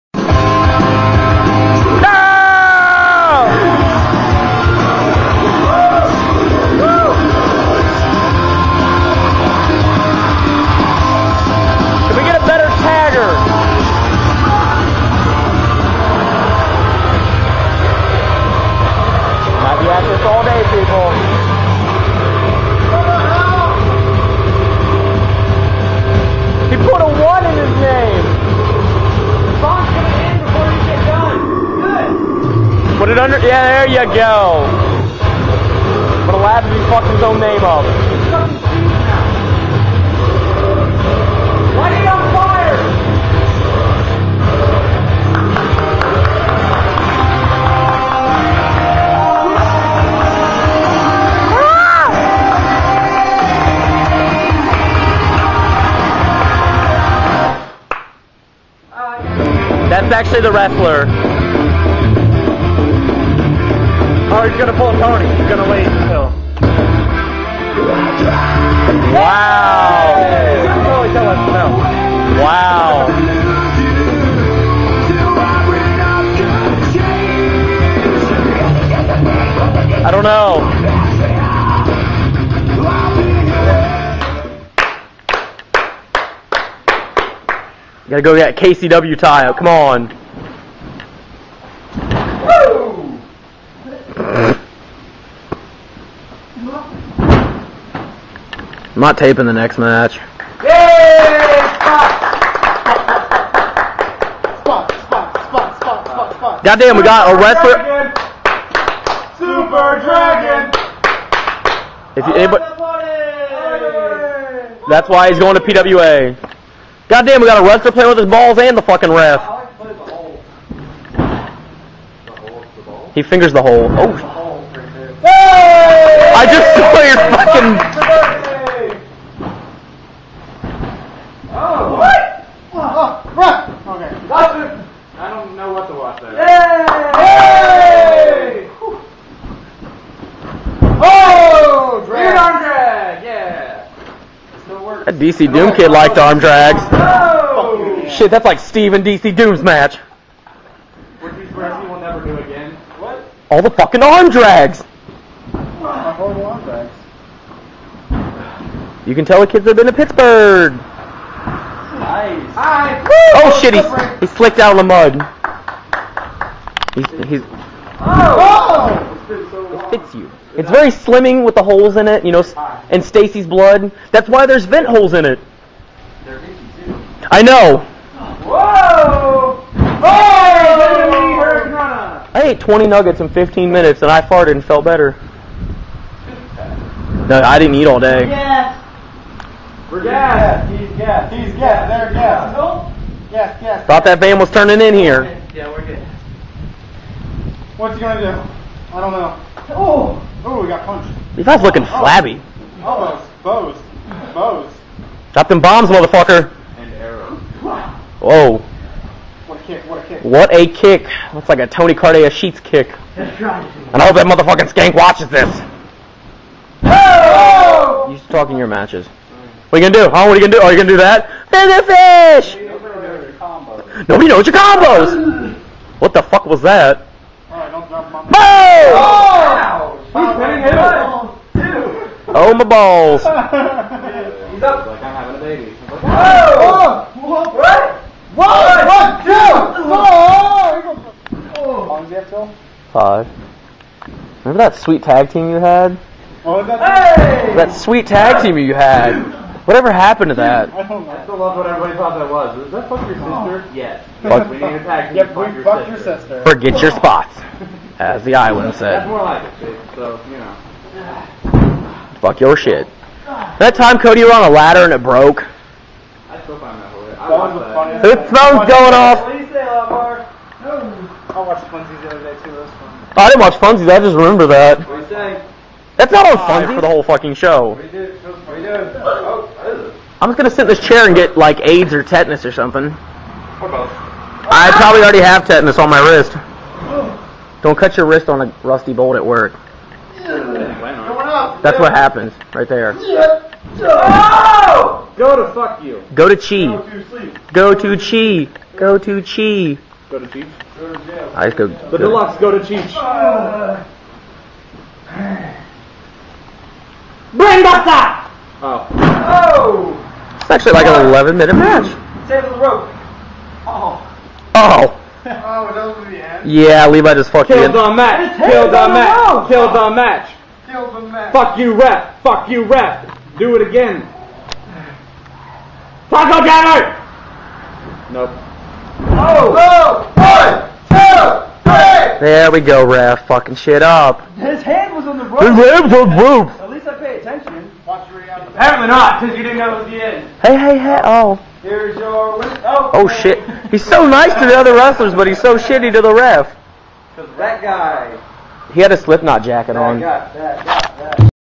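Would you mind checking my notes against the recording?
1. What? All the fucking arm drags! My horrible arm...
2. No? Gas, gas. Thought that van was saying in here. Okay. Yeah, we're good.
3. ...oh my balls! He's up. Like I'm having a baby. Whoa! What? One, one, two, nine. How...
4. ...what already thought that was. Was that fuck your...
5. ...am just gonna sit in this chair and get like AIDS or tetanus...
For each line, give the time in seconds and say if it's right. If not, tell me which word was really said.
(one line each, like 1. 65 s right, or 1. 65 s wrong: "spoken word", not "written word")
1. 152 s right
2. 192 s wrong: "turning", not "saying"
3. 232 s wrong: "four", not "nine"
4. 251 s wrong: "everybody", not "already"
5. 280 s right.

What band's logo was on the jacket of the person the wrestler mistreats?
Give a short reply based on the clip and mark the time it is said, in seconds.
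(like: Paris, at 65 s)
Slipknot, at 348 s.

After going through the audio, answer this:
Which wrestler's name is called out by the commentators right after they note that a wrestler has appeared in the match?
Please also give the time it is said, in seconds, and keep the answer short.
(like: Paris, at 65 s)
Super Dragon, at 109 s.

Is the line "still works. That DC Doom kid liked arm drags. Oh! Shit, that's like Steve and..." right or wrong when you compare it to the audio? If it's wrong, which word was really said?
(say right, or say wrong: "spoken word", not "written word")
right.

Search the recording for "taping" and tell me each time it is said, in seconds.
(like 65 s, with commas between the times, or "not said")
99 s.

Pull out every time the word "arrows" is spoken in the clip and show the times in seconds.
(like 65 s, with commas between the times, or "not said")
206 s.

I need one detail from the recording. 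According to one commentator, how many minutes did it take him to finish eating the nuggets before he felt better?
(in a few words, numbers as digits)
15.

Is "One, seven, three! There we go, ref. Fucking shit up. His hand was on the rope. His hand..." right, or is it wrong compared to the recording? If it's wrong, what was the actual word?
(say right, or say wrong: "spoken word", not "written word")
wrong: "two", not "seven".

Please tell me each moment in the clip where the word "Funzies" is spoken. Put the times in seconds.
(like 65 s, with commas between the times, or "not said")
271 s, 276 s.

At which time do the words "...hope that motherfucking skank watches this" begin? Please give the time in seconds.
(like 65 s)
214 s.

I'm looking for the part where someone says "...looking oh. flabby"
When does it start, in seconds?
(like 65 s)
201 s.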